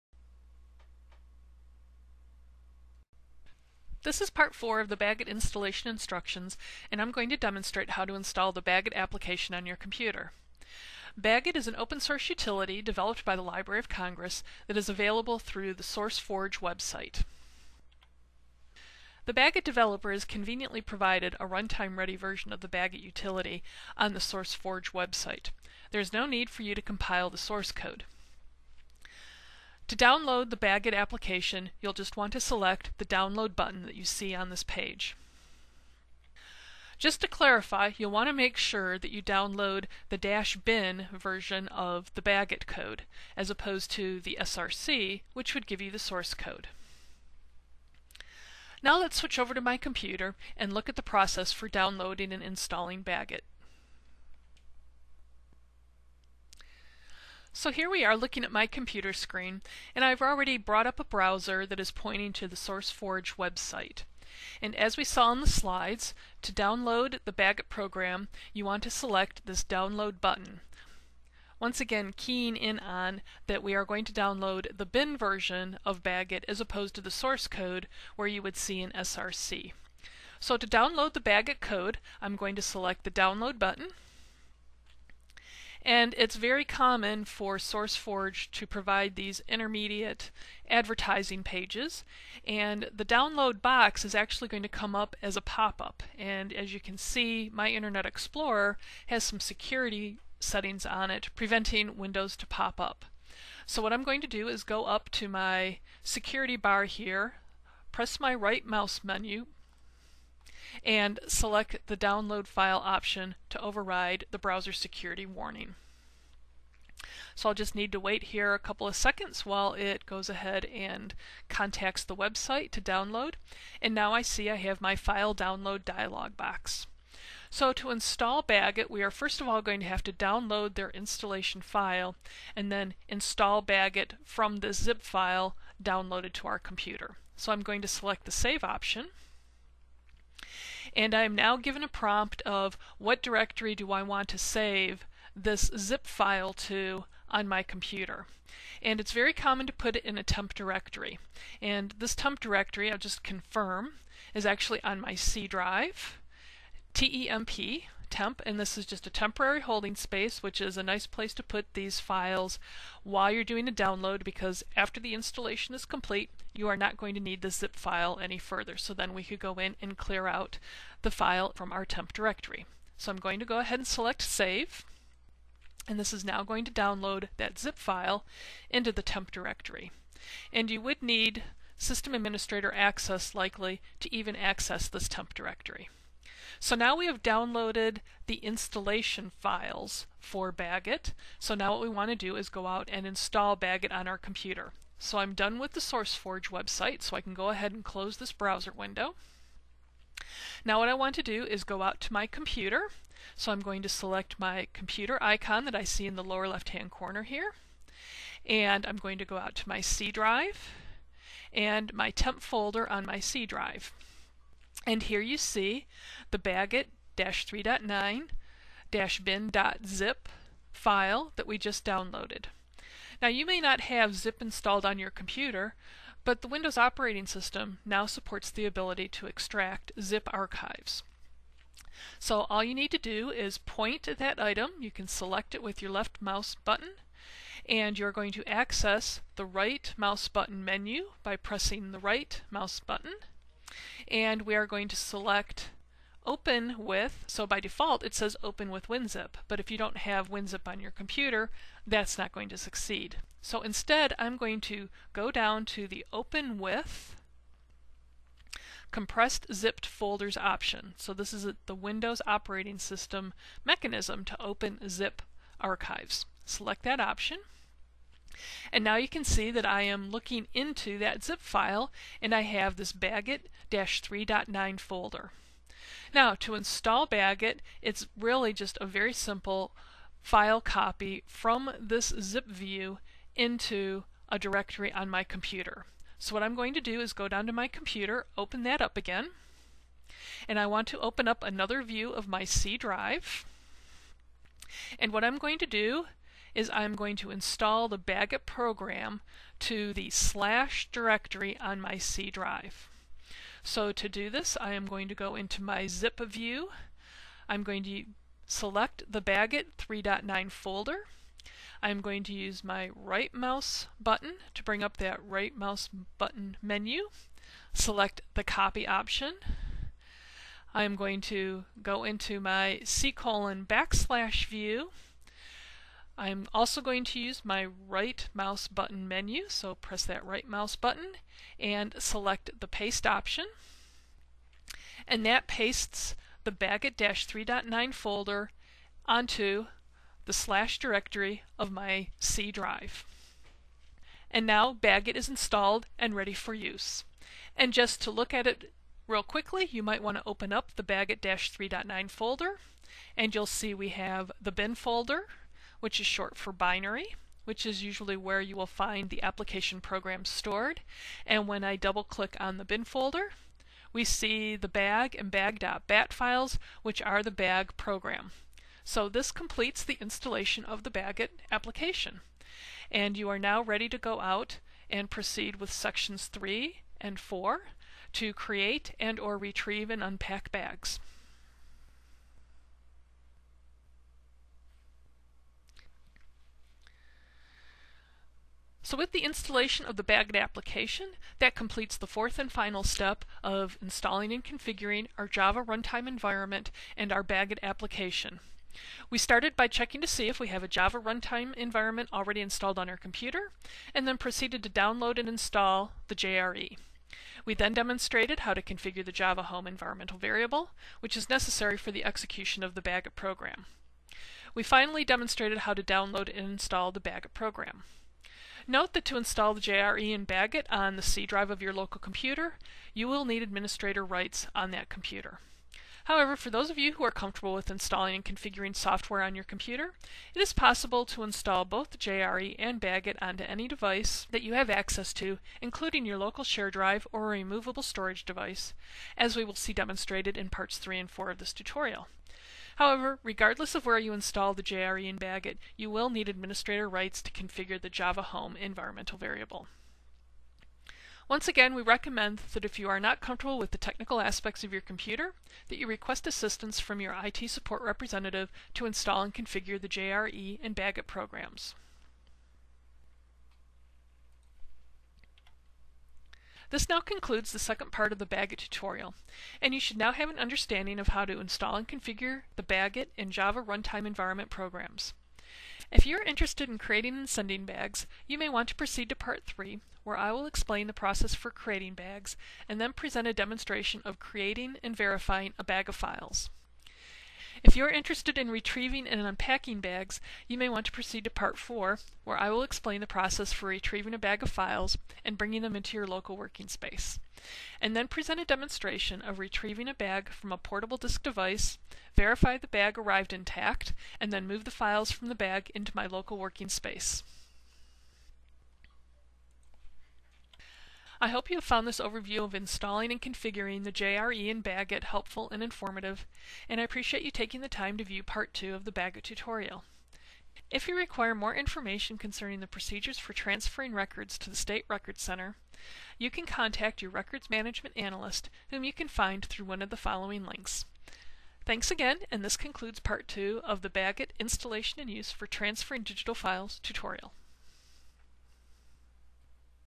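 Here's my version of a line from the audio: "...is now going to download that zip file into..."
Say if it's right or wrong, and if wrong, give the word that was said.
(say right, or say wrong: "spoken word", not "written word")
right.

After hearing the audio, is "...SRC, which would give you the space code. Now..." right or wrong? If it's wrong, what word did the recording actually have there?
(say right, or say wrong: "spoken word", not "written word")
wrong: "source", not "space".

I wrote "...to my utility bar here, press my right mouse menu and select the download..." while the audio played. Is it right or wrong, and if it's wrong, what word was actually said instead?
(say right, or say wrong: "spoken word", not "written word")
wrong: "security", not "utility".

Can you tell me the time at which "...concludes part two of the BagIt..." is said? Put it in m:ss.
8:52.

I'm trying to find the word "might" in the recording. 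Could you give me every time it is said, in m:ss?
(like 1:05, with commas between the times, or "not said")
5:49.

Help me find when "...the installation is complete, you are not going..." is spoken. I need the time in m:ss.
2:44.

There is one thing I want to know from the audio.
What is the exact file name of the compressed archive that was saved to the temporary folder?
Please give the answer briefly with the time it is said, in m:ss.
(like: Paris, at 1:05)
bagit-3.9-bin.zip, at 3:36.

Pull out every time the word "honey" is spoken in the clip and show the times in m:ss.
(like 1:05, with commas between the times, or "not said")
not said.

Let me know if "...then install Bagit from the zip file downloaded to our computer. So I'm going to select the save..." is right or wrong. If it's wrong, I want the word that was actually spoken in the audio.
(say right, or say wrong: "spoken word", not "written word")
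right.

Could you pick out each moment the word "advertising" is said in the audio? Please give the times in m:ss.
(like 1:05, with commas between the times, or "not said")
1:30.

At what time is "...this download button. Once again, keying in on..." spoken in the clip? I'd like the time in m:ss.
1:09.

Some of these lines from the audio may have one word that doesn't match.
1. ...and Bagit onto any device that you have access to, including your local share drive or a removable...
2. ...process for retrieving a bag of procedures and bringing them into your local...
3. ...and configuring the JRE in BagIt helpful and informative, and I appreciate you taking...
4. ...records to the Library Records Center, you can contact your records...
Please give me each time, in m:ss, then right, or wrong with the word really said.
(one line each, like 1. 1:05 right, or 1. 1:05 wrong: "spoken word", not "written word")
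1. 7:12 right
2. 8:13 wrong: "files", not "procedures"
3. 8:33 right
4. 8:43 wrong: "State", not "Library".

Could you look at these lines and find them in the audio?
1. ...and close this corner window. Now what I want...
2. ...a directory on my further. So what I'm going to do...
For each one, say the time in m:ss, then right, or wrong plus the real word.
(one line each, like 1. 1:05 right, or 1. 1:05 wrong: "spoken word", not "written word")
1. 3:17 wrong: "browser", not "corner"
2. 4:44 wrong: "computer", not "further".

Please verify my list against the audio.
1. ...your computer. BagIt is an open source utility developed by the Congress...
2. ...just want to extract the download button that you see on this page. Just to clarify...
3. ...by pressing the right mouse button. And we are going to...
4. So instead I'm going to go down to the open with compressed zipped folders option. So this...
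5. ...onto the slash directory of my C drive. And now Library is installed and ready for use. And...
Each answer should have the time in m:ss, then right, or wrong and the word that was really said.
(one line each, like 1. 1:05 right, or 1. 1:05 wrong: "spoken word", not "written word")
1. 0:09 wrong: "Library", not "Congress"
2. 0:31 wrong: "select", not "extract"
3. 4:01 right
4. 4:13 right
5. 5:39 wrong: "BagIt", not "Library".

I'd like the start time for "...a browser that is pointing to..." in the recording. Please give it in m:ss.
1:01.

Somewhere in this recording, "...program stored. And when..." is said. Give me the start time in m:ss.
5:59.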